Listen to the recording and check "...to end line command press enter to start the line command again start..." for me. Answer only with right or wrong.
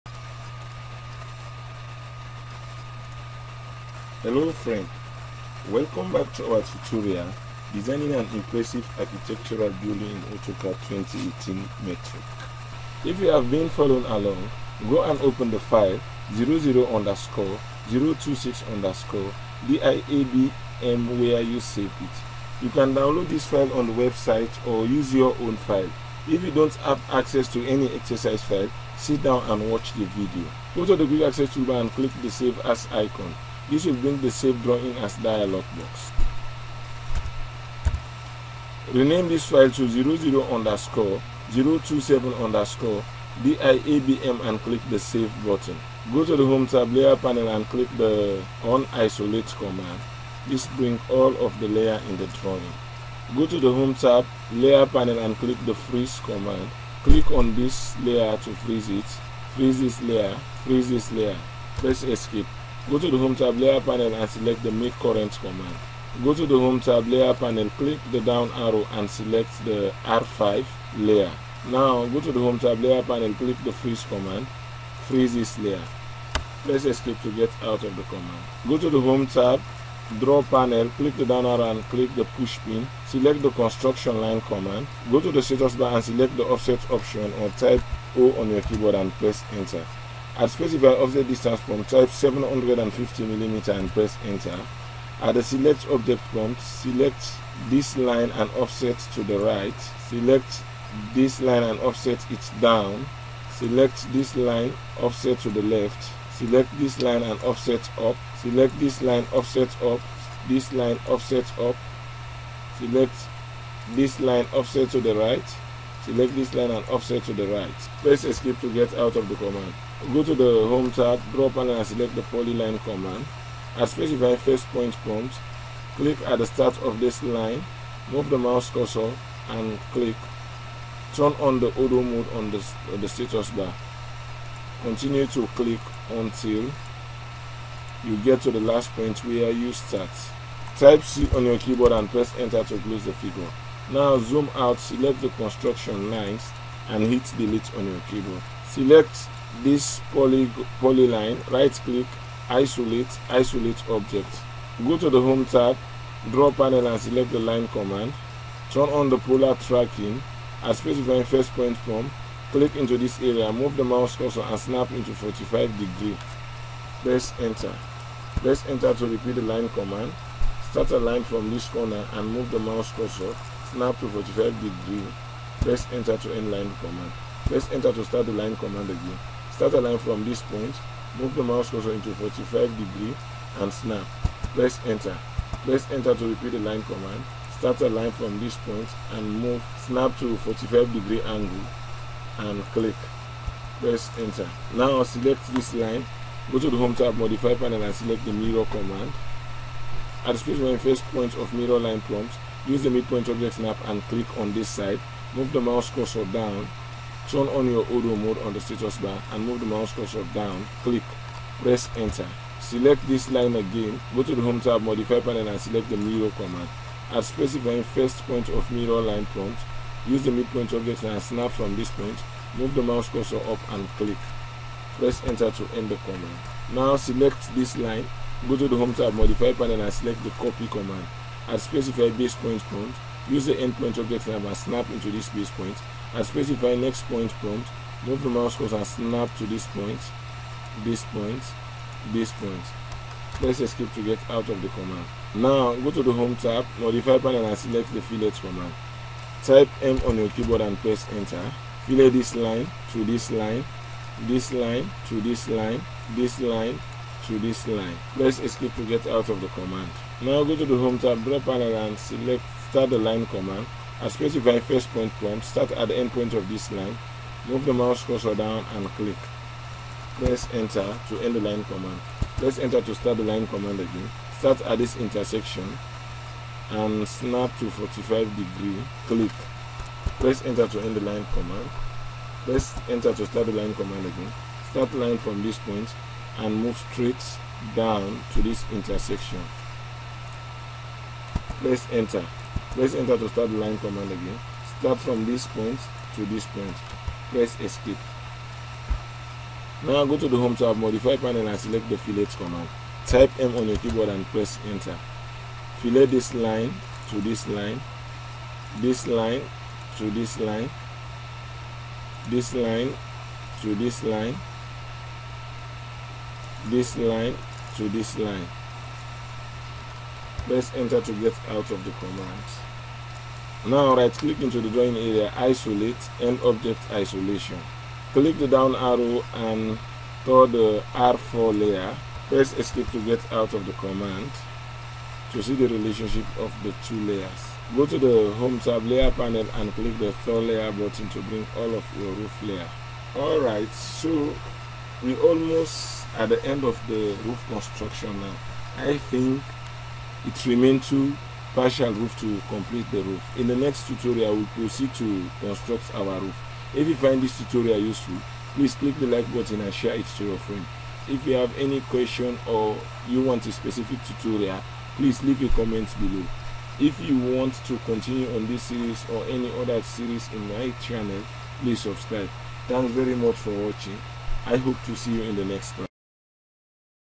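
right.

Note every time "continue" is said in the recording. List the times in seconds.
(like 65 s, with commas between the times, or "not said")
134 s, 367 s.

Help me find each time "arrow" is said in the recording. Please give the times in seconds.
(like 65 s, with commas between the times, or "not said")
68 s, 81 s, 328 s.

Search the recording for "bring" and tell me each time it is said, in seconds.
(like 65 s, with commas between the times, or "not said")
34 s, 50 s, 341 s.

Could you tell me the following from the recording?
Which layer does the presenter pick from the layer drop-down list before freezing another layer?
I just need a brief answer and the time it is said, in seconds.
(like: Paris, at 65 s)
R5, at 70 s.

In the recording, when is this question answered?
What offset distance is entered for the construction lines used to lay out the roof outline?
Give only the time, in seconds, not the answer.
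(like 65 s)
92 s.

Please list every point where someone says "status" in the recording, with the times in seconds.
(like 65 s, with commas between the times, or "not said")
85 s, 133 s, 208 s.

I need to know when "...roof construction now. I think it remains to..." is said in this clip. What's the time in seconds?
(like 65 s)
347 s.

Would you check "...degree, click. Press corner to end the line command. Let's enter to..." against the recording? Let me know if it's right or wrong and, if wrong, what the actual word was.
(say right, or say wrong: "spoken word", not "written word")
wrong: "enter", not "corner".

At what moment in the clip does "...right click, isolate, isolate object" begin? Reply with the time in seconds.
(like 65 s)
151 s.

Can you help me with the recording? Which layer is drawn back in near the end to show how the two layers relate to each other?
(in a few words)
R4.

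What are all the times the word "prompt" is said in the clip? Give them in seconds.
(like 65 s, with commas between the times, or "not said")
91 s, 96 s, 125 s, 202 s, 219 s, 232 s, 237 s, 265 s.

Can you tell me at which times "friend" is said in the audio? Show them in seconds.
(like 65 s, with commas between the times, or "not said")
4 s, 360 s.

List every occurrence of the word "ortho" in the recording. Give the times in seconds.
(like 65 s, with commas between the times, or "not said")
131 s, 207 s.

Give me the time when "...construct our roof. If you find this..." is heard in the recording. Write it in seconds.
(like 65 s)
355 s.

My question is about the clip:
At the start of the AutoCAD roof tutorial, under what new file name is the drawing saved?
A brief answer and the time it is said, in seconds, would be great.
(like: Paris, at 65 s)
00_027_DIABM, at 39 s.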